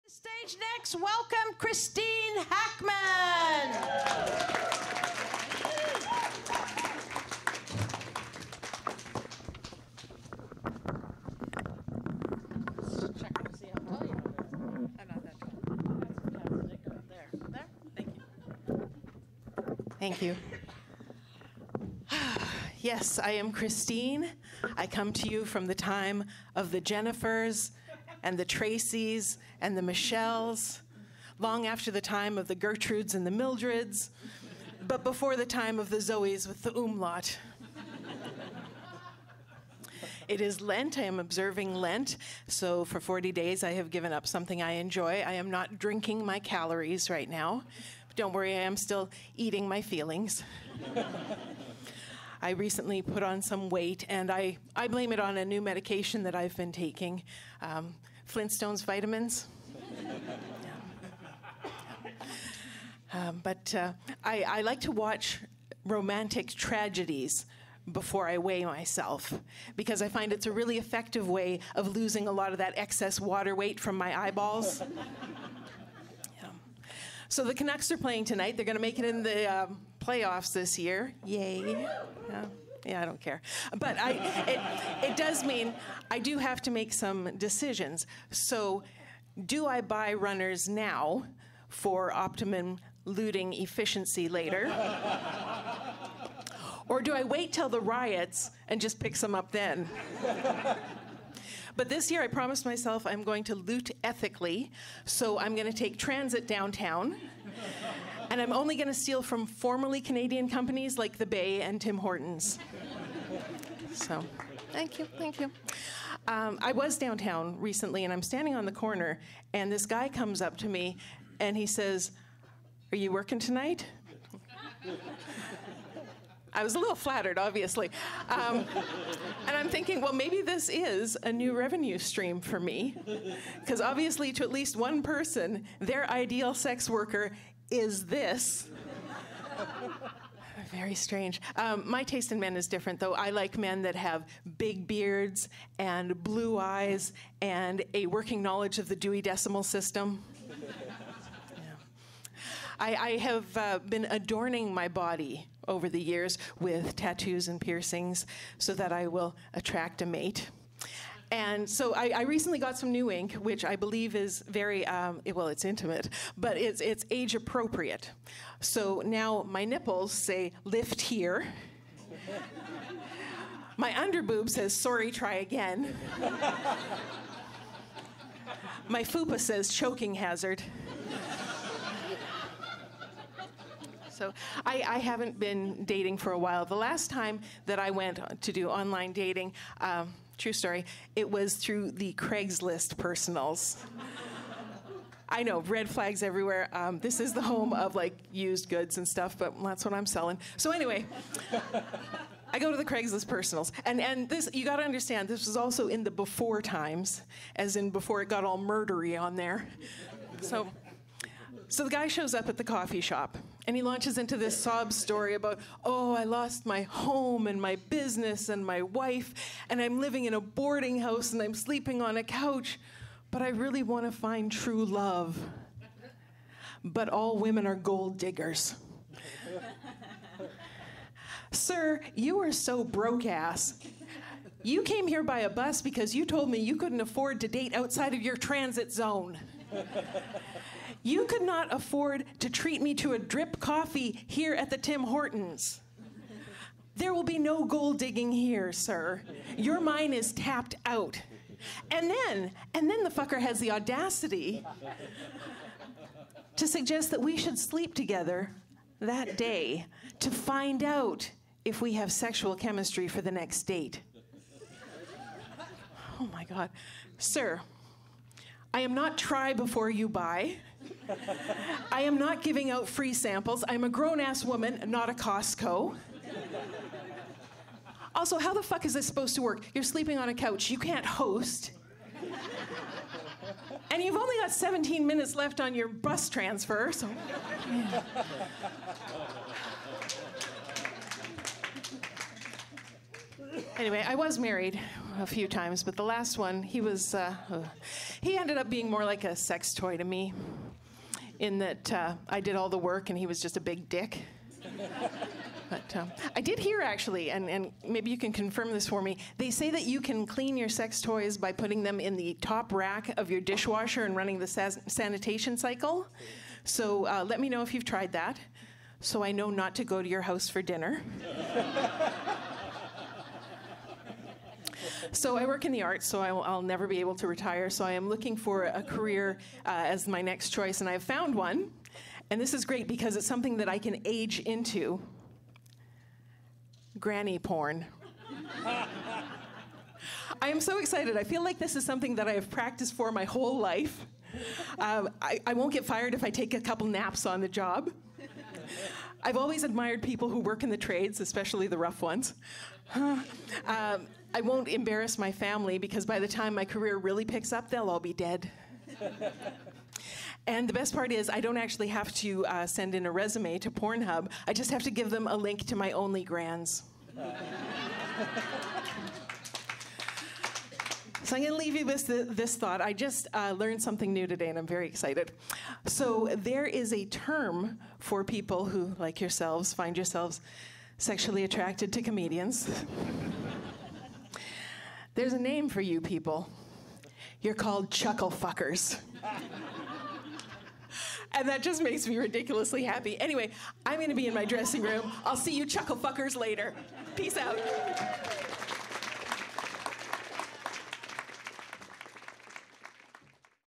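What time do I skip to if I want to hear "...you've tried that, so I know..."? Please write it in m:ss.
5:17.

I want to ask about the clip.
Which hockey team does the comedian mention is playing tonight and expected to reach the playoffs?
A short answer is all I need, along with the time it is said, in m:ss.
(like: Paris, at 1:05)
Canucks, at 1:17.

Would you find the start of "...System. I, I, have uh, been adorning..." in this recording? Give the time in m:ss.
2:29.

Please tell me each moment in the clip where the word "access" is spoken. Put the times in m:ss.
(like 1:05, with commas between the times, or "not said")
not said.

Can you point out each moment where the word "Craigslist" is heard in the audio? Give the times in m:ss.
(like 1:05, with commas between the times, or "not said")
3:12, 3:22.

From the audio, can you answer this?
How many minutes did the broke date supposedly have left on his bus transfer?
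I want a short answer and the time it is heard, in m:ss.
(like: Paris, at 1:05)
17, at 4:44.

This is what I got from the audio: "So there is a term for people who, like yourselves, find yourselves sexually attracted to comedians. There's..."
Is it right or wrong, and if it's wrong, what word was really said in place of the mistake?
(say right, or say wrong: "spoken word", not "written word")
right.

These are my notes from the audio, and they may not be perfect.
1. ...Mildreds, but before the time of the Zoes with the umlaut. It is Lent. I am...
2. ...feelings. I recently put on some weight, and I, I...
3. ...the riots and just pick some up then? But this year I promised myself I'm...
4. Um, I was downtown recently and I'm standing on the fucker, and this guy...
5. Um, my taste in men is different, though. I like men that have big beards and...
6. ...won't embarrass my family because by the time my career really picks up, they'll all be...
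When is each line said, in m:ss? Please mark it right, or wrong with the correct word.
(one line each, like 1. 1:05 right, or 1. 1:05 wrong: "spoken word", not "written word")
1. 0:33 right
2. 0:49 right
3. 1:37 right
4. 1:56 wrong: "corner", not "fucker"
5. 2:21 right
6. 5:54 right.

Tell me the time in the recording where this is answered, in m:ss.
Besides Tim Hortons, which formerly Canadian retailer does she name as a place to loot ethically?
1:51.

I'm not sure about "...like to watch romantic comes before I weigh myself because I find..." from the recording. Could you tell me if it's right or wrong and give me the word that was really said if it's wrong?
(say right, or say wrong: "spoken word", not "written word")
wrong: "tragedies", not "comes".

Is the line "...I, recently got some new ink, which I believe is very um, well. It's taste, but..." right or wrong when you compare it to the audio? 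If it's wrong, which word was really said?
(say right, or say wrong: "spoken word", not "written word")
wrong: "intimate", not "taste".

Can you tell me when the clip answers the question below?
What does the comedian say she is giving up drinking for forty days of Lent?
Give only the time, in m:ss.
0:46.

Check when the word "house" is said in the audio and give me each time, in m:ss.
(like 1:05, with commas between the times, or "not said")
3:40, 5:20.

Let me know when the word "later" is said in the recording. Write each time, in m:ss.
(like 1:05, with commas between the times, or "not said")
1:34, 6:36.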